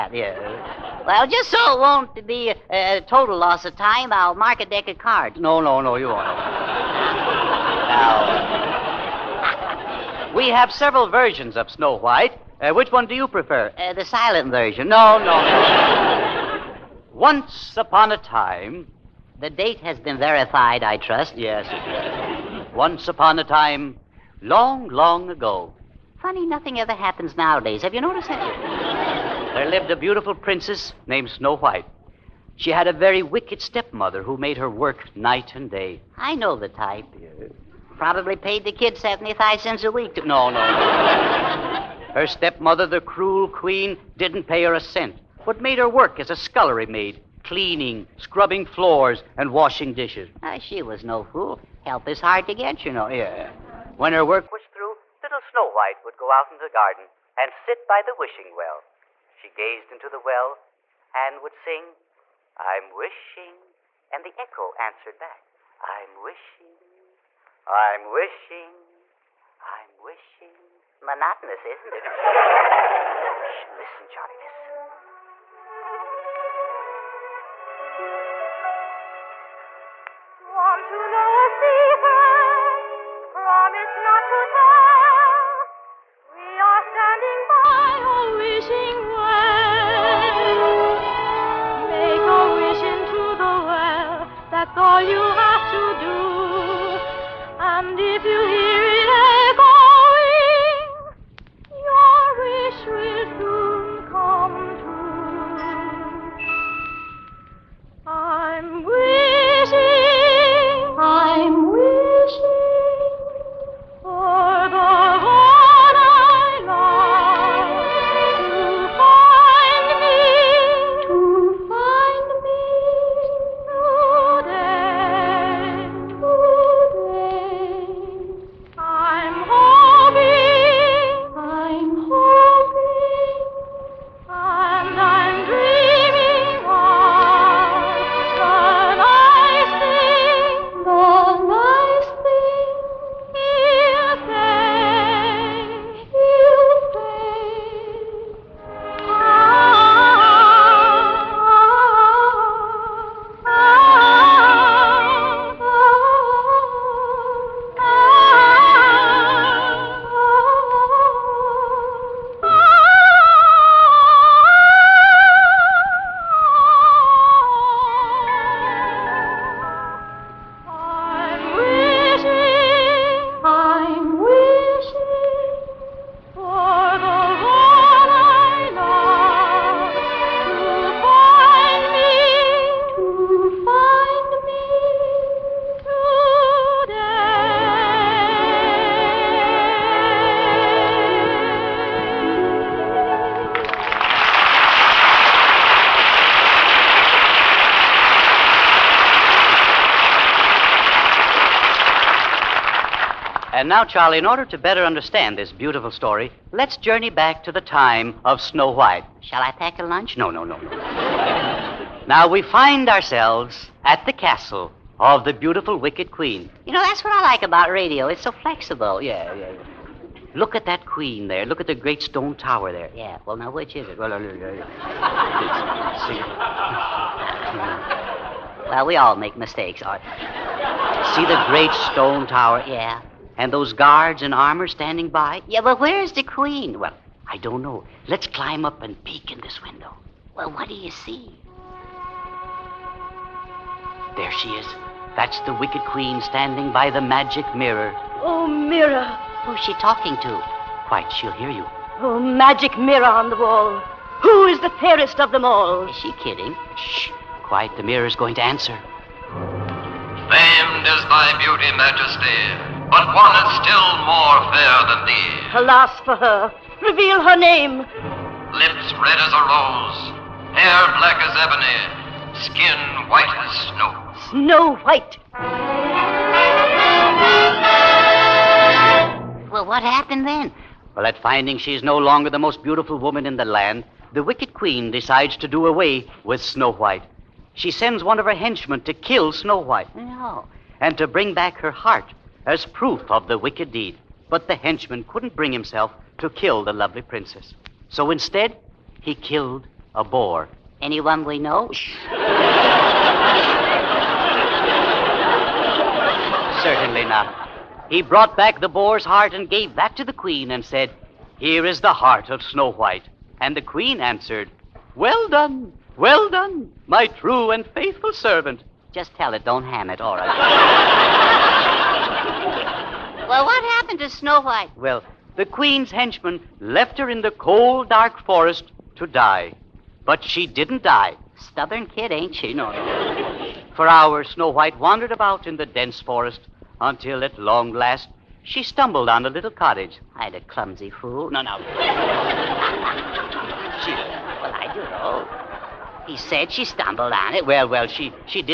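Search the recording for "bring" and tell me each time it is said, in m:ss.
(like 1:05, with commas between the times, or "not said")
4:51, 4:55.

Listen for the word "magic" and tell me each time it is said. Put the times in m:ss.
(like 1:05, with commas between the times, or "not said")
4:06, 4:12.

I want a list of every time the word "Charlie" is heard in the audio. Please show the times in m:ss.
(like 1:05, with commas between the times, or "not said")
1:14, 3:23.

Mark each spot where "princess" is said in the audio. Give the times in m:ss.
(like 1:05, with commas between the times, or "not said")
0:30, 4:57.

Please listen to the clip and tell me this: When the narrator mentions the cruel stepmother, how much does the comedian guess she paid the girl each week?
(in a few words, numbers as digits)
75 cents.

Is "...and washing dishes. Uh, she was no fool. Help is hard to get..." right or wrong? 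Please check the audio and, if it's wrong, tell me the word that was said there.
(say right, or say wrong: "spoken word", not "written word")
right.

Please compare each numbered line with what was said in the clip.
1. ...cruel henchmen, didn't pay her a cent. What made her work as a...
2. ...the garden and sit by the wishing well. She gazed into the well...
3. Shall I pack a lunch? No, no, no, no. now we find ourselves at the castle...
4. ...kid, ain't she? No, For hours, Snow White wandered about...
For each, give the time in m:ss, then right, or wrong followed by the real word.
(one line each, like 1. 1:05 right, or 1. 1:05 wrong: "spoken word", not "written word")
1. 0:43 wrong: "queen", not "henchmen"
2. 0:56 right
3. 3:29 right
4. 5:31 right.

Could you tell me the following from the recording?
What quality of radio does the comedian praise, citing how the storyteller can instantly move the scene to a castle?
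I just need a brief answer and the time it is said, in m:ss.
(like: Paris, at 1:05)
It's so flexible, at 3:38.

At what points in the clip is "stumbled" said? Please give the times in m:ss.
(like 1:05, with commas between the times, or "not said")
5:38, 5:46.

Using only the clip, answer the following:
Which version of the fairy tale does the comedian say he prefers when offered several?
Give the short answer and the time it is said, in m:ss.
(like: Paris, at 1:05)
The silent version, at 0:13.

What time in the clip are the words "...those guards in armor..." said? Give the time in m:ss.
3:53.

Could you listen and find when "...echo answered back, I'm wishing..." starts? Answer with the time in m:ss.
1:04.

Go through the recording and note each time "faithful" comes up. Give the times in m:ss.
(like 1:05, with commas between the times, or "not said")
5:17.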